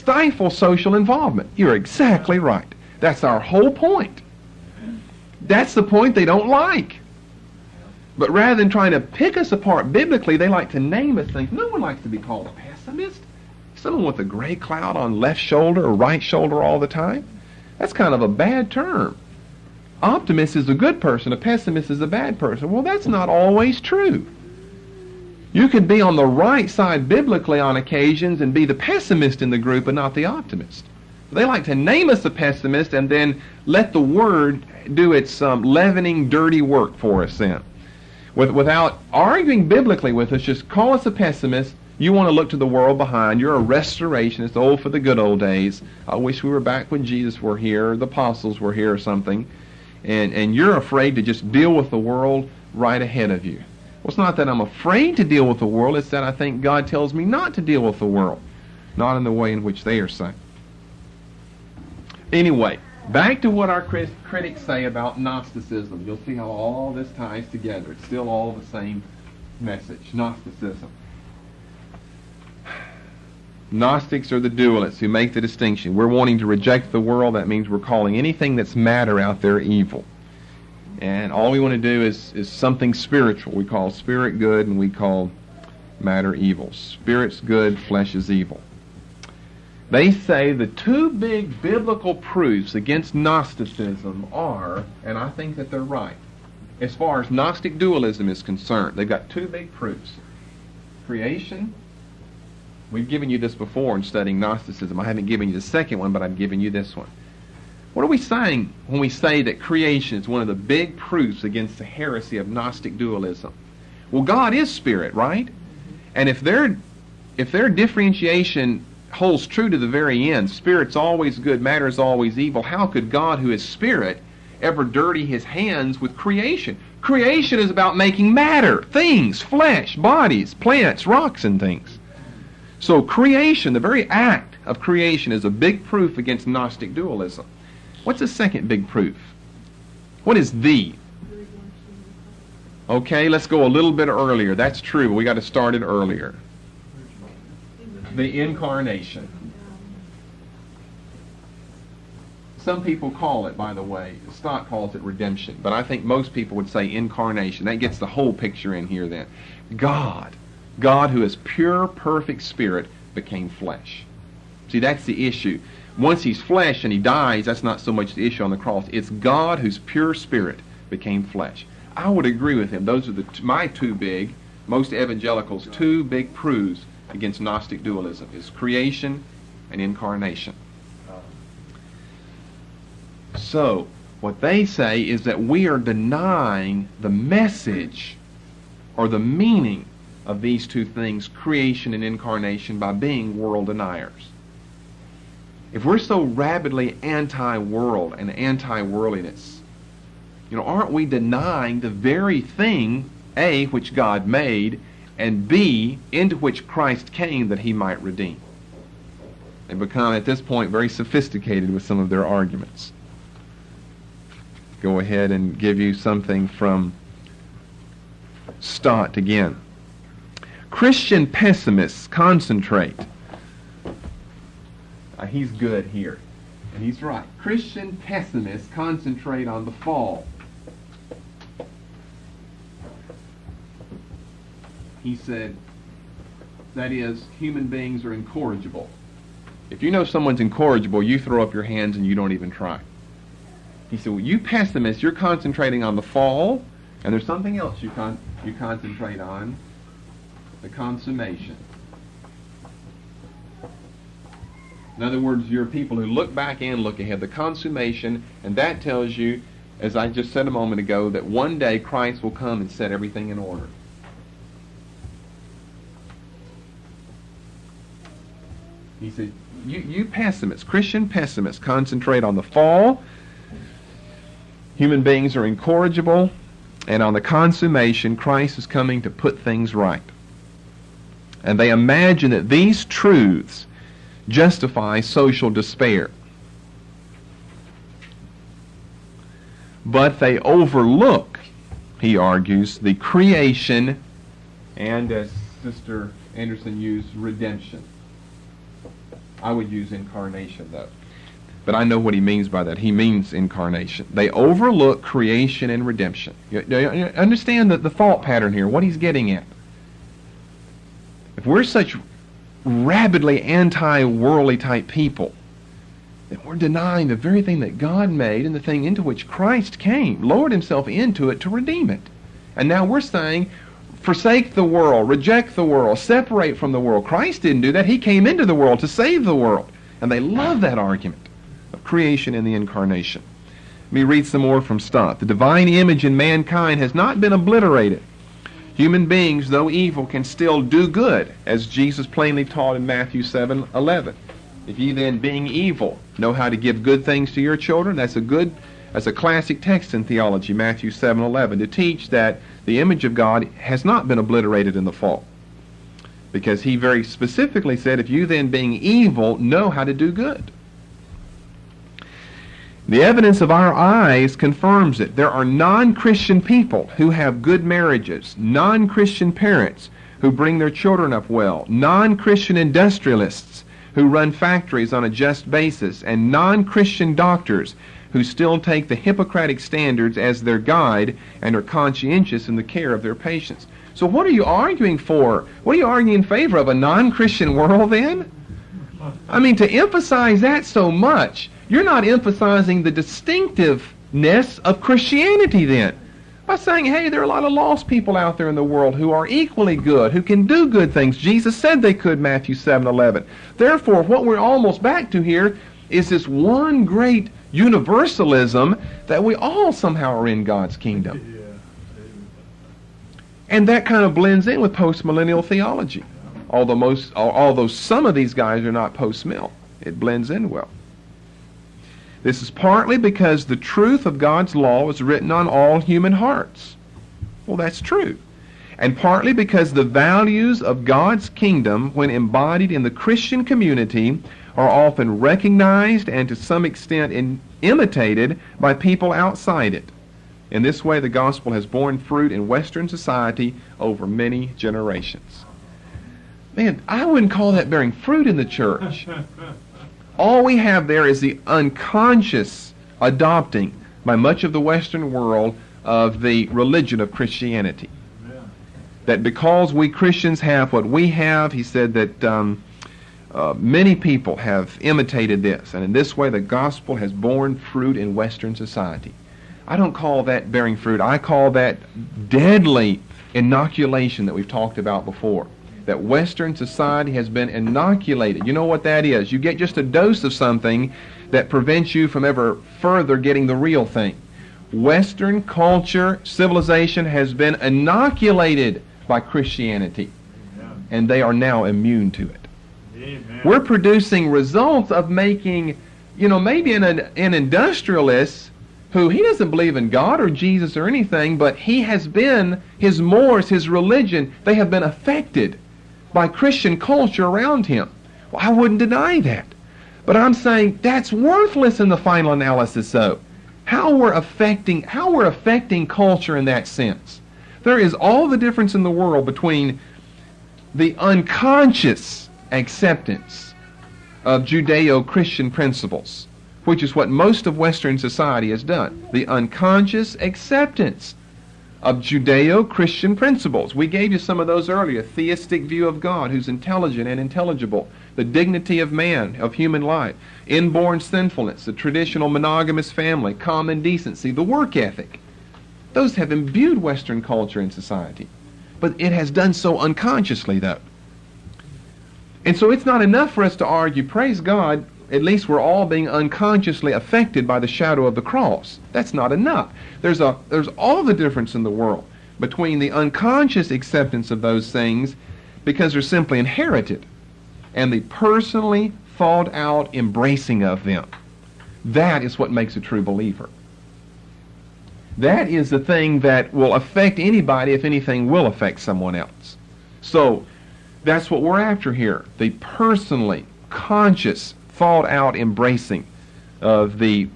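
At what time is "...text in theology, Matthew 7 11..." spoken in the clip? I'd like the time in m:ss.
5:49.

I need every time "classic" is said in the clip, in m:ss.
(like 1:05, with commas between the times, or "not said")
5:49.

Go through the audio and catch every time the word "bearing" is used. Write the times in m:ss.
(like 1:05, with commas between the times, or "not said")
7:27, 7:50.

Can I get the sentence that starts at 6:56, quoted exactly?
Although most although some of these guys are not post-mill, it blends in well.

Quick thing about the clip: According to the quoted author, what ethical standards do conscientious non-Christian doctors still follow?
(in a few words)
Hippocratic standards.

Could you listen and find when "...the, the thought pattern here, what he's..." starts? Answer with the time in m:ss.
5:07.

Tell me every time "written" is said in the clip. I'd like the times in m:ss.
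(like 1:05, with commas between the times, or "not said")
7:05.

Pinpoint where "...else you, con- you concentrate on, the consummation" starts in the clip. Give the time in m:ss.
4:07.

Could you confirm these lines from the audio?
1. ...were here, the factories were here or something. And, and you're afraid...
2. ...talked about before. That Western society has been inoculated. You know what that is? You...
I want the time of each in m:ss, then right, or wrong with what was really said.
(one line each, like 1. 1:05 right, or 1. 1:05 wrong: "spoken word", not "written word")
1. 0:47 wrong: "apostles", not "factories"
2. 7:54 right.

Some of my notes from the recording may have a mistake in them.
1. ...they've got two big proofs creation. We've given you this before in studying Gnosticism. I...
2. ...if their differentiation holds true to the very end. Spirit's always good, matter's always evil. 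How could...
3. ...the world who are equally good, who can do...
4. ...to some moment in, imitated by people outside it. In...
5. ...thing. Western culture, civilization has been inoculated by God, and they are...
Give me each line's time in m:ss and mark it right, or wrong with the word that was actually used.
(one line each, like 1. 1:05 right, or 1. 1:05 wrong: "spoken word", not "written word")
1. 1:38 right
2. 1:57 right
3. 6:38 right
4. 7:16 wrong: "extent", not "moment"
5. 8:03 wrong: "Christianity", not "God".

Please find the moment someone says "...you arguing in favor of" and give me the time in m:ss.
6:25.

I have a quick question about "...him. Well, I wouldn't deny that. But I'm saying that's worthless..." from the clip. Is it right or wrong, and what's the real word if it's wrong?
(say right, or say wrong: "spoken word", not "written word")
right.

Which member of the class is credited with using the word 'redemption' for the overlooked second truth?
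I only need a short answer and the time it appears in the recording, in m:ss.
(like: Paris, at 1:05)
Sister Anderson, at 4:55.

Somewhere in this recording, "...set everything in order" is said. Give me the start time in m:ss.
4:22.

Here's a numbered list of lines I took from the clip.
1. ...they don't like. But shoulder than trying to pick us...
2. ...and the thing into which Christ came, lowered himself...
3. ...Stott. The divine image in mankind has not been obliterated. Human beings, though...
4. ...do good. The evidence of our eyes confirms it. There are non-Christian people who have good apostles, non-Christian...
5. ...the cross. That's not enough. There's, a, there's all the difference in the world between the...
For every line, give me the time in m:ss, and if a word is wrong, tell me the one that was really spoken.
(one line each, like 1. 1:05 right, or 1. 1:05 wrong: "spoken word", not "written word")
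1. 0:06 wrong: "rather", not "shoulder"
2. 5:18 right
3. 5:34 right
4. 5:59 wrong: "marriages", not "apostles"
5. 9:18 right.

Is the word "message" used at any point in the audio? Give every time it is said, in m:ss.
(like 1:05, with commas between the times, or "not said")
1:09, 3:07.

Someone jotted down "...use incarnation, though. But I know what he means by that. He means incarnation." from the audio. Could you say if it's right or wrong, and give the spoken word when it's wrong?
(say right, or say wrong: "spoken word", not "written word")
right.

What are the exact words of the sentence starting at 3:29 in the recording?
They become, at this point, very sophisticated with some of their arguments.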